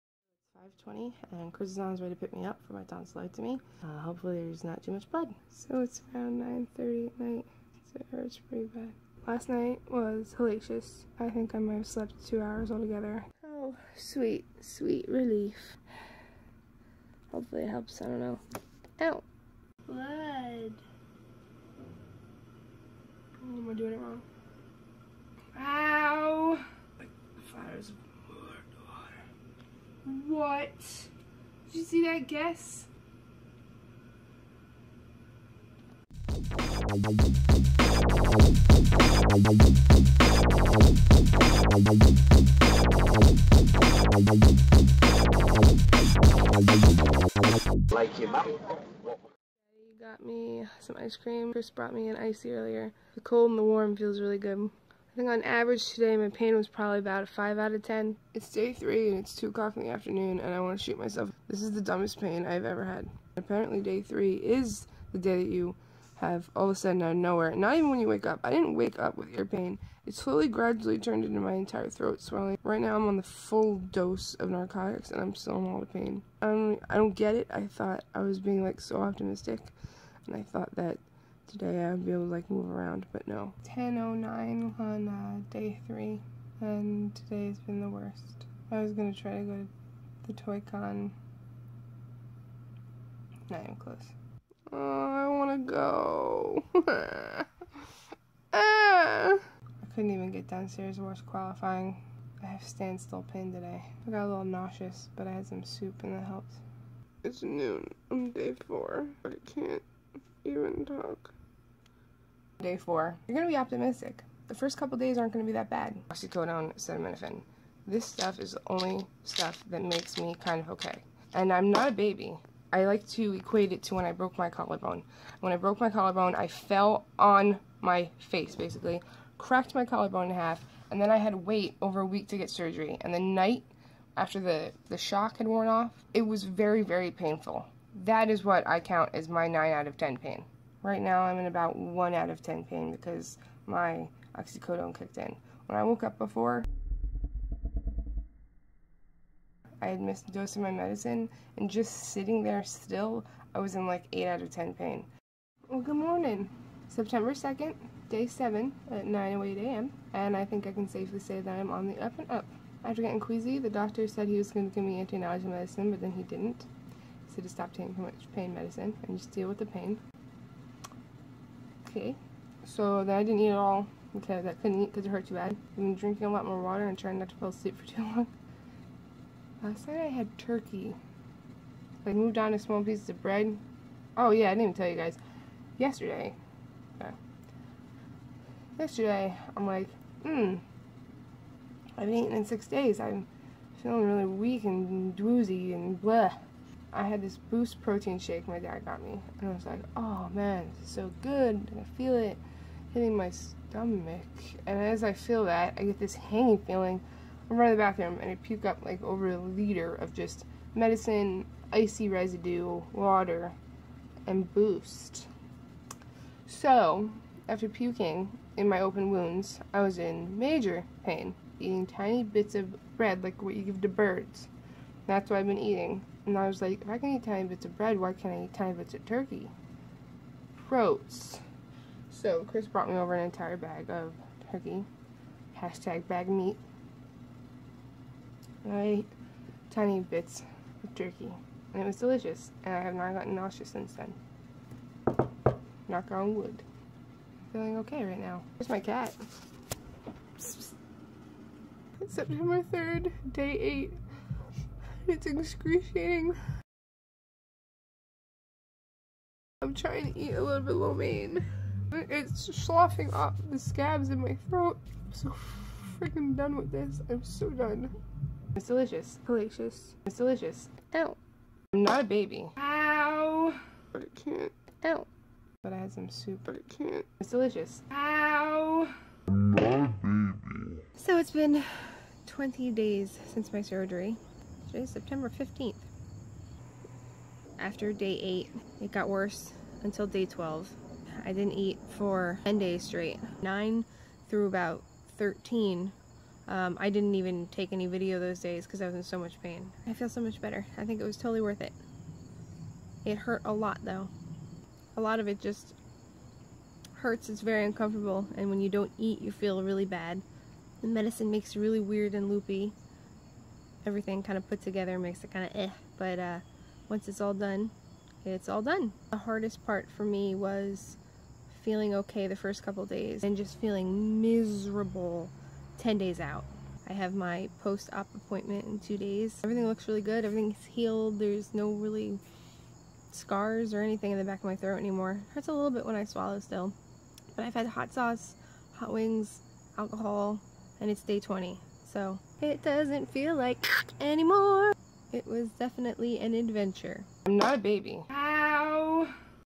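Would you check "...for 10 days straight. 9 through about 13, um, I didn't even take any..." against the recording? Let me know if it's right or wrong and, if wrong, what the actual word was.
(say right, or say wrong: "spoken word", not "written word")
right.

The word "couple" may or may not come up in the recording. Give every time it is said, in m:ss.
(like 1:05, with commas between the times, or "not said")
1:54, 5:22.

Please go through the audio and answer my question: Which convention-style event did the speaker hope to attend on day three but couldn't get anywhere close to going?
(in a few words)
Toy Con.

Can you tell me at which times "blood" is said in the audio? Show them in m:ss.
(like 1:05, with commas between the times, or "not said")
0:05, 0:19.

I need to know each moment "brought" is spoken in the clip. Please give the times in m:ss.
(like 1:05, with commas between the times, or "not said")
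0:51, 3:52.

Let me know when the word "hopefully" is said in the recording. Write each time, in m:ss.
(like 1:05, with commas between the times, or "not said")
0:03, 0:17.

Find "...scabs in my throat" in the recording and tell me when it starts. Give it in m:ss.
4:23.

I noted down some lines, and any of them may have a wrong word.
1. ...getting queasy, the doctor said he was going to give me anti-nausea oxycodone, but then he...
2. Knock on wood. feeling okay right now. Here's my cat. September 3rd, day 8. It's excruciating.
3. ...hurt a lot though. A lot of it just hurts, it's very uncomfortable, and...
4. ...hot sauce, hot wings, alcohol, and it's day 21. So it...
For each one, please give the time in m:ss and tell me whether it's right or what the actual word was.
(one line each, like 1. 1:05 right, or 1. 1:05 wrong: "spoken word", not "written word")
1. 2:43 wrong: "medicine", not "oxycodone"
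2. 4:05 right
3. 5:03 right
4. 5:37 wrong: "20", not "21".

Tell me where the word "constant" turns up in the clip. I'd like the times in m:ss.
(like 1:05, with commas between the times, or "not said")
not said.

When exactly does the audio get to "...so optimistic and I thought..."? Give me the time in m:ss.
1:18.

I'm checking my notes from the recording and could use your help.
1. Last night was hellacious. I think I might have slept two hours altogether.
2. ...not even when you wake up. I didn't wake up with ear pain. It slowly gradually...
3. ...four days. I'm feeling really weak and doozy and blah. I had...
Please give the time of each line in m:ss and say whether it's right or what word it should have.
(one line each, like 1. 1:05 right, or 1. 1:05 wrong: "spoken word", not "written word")
1. 0:09 right
2. 1:07 right
3. 3:12 wrong: "six", not "four".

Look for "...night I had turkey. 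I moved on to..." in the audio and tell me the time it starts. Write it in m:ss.
2:59.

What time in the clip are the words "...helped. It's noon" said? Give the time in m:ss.
1:46.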